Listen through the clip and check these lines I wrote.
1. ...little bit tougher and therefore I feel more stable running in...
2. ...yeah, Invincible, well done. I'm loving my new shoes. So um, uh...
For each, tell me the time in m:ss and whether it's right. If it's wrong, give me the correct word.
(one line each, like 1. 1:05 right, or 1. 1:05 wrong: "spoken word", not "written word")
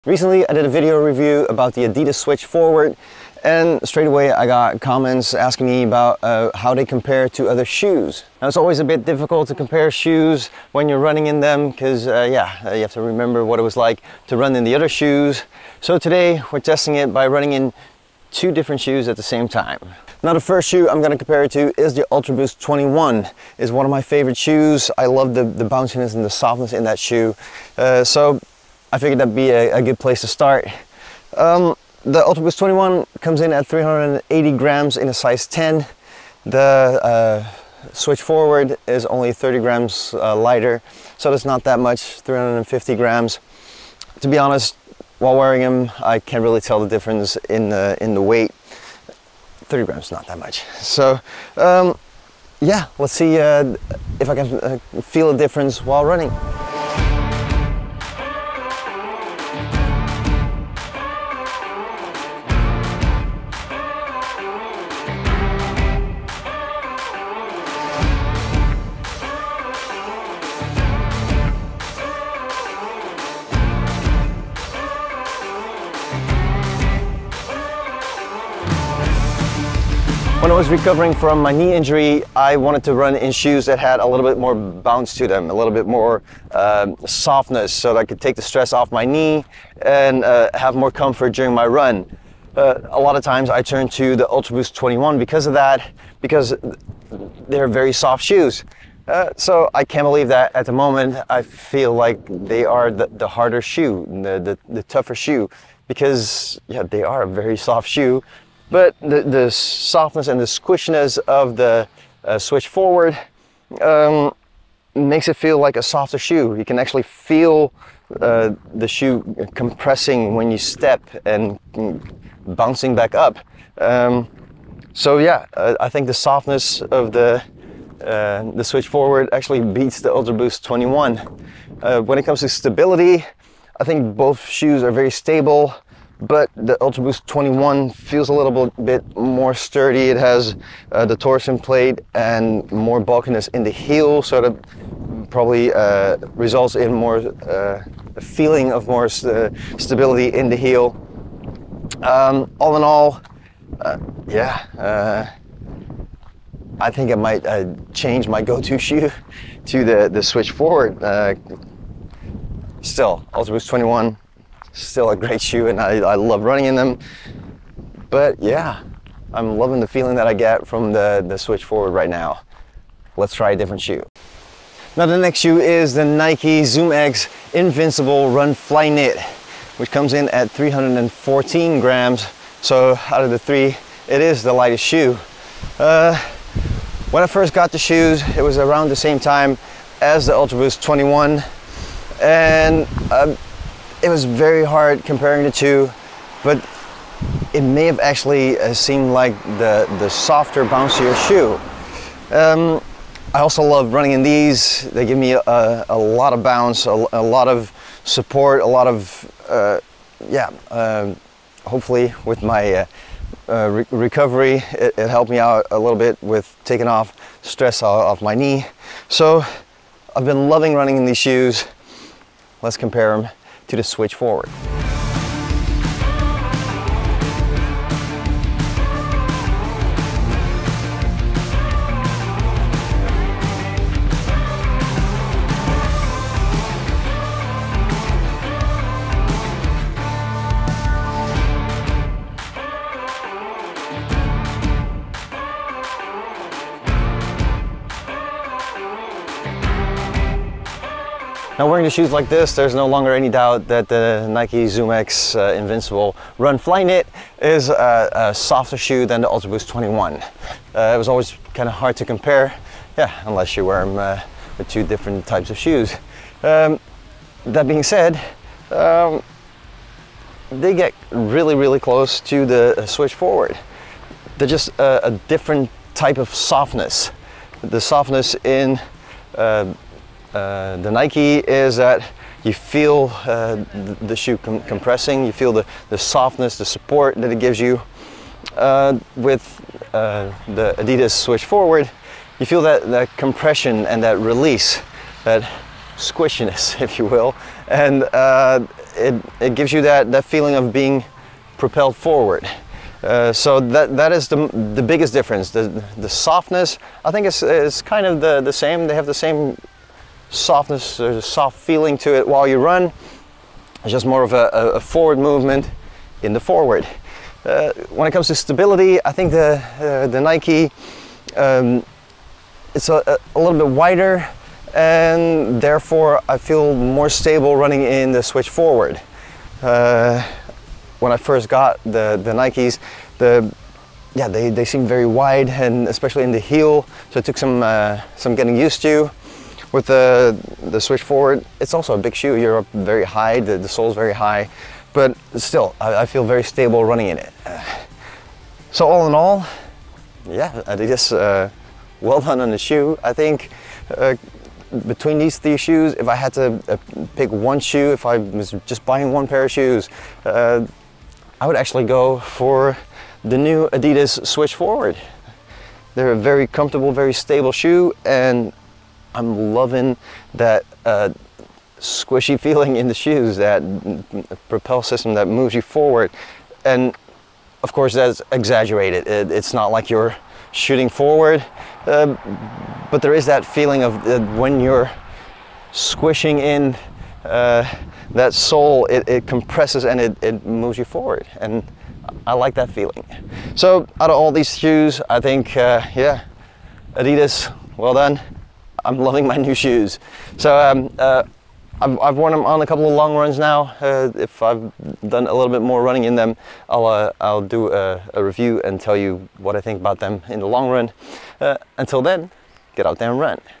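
1. 5:23 wrong: "wider", not "tougher"
2. 6:35 wrong: "Adidas", not "Invincible".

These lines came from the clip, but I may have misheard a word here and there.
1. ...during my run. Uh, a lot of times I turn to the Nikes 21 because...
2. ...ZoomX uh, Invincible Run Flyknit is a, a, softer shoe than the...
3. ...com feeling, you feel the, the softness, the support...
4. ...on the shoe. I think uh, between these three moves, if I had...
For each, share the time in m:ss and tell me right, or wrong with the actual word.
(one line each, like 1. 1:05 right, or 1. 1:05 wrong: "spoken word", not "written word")
1. 1:31 wrong: "UltraBoost", not "Nikes"
2. 4:14 right
3. 4:44 wrong: "compressing", not "feeling"
4. 5:52 wrong: "shoes", not "moves".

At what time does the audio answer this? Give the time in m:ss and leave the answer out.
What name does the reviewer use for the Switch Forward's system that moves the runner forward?
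6:14.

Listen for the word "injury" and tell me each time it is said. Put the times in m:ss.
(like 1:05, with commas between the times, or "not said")
1:21.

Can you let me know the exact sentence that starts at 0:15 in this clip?
So today we're testing it by running in two different shoes at the same time.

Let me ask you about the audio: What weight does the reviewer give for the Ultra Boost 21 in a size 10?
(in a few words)
380 grams.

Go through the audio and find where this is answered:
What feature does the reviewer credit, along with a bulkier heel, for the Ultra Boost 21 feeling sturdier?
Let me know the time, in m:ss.
2:21.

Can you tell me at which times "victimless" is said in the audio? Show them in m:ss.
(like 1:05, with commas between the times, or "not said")
not said.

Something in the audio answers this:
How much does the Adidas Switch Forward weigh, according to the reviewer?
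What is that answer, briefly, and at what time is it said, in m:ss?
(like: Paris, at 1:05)
350 grams, at 0:42.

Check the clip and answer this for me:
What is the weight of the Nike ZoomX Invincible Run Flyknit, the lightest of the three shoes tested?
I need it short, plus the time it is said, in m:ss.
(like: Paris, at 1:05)
314 grams, at 3:00.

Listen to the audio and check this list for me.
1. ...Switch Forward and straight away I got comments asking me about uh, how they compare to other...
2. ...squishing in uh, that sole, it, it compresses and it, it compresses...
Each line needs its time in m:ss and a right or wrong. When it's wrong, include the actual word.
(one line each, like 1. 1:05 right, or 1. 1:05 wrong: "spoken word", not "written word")
1. 0:02 right
2. 6:25 wrong: "moves", not "compresses".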